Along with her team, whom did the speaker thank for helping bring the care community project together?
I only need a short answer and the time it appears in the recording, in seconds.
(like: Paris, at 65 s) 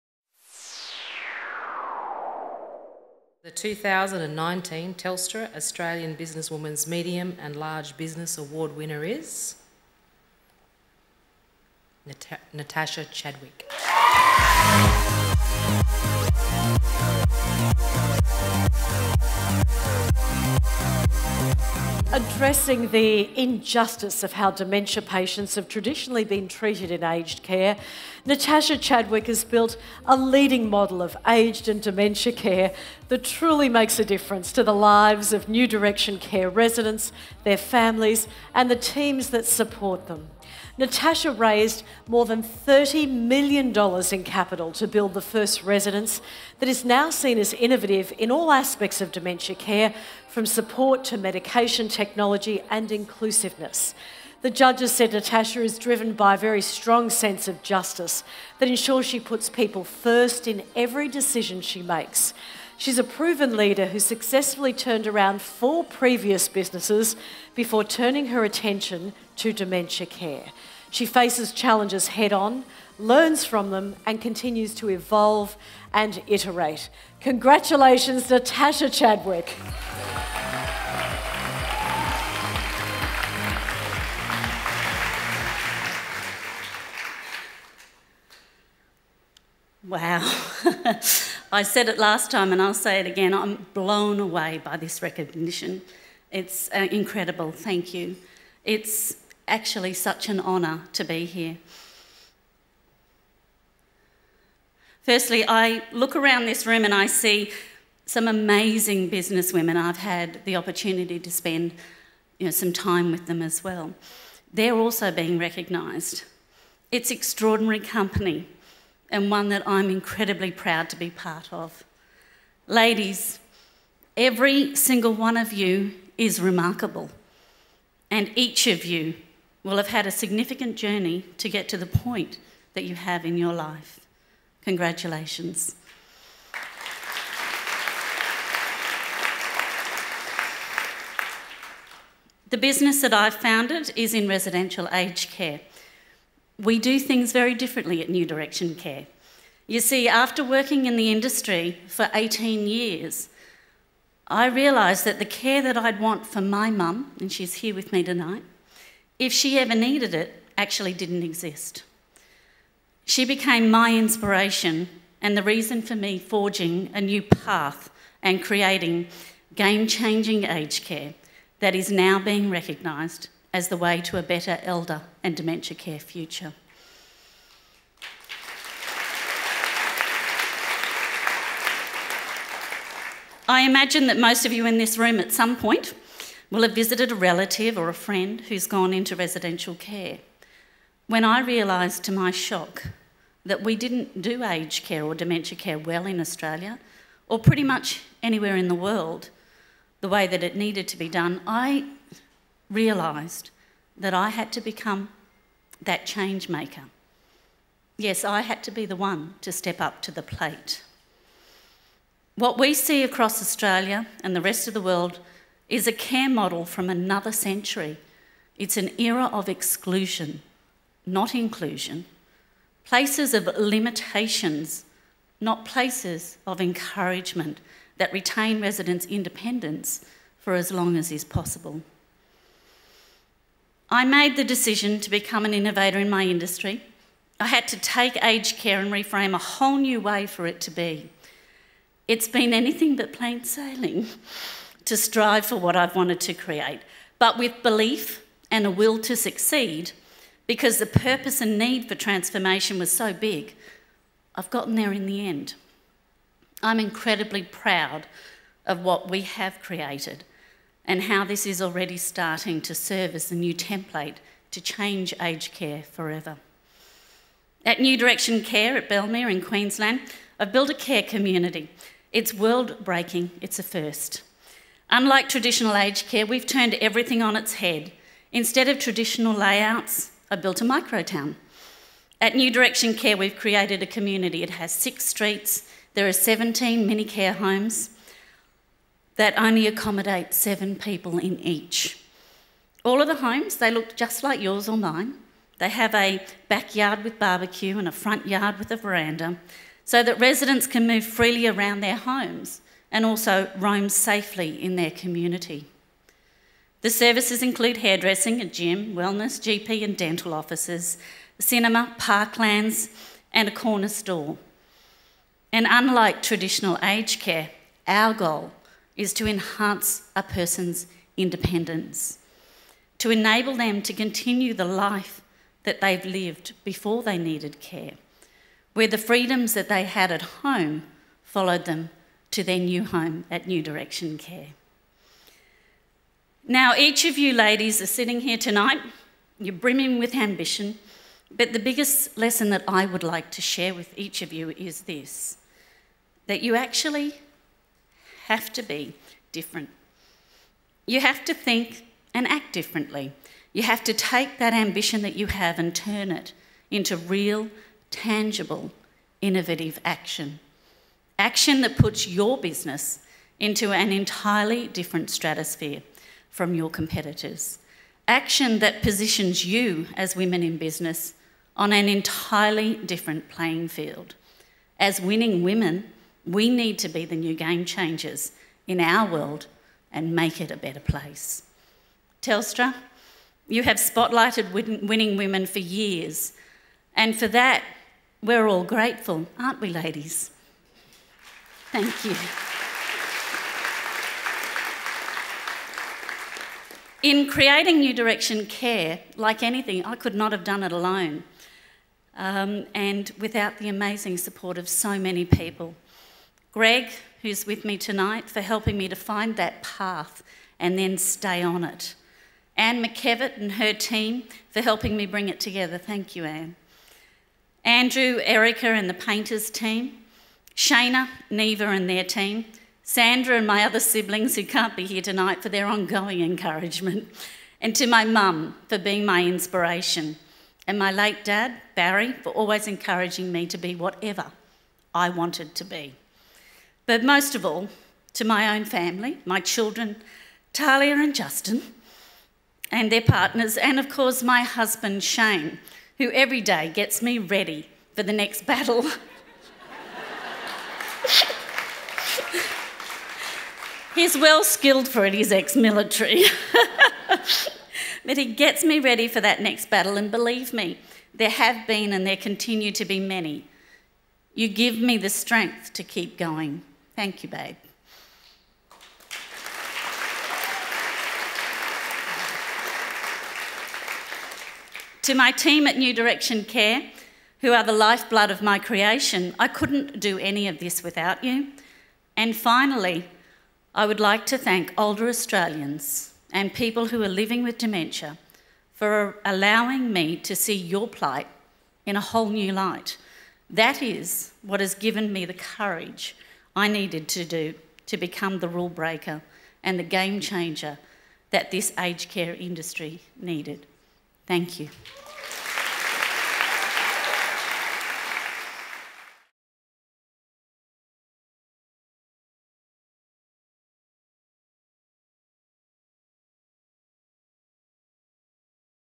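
Anne McKevitt, at 412 s.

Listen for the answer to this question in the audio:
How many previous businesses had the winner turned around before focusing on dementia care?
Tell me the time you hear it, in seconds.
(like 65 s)
65 s.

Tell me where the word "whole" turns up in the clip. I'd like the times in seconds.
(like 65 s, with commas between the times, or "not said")
239 s, 492 s.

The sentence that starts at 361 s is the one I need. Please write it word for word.
Action that puts your business into an entirely different stratosphere from your competitors.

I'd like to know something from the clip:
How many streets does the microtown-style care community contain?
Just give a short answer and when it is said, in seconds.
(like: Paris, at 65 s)
6, at 284 s.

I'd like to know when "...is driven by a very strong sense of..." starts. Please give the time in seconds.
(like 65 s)
55 s.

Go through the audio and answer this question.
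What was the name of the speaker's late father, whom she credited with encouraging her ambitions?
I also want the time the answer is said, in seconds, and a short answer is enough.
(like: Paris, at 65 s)
Barry, at 431 s.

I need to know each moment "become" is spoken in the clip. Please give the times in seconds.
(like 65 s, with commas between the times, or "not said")
204 s, 235 s, 497 s.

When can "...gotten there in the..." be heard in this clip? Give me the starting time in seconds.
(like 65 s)
254 s.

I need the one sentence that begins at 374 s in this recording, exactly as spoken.
As winning women, we need to be the new game changers in our world and make it a better place.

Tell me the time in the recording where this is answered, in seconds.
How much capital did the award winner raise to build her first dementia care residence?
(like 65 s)
42 s.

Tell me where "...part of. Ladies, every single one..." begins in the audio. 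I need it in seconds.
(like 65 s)
121 s.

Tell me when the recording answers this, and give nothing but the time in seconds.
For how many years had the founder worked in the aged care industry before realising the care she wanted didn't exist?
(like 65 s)
152 s.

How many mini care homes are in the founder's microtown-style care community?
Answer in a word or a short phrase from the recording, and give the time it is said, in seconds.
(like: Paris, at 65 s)
17, at 286 s.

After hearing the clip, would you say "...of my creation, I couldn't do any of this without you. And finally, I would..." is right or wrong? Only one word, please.
right.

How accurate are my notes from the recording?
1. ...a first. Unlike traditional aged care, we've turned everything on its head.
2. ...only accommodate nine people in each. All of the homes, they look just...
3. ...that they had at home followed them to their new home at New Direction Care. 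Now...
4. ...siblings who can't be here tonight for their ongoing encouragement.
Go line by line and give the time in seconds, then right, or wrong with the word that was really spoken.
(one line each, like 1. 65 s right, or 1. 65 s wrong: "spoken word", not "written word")
1. 273 s right
2. 289 s wrong: "seven", not "nine"
3. 329 s right
4. 423 s right.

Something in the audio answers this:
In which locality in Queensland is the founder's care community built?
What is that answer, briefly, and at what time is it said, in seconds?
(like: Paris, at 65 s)
Bellmere, at 268 s.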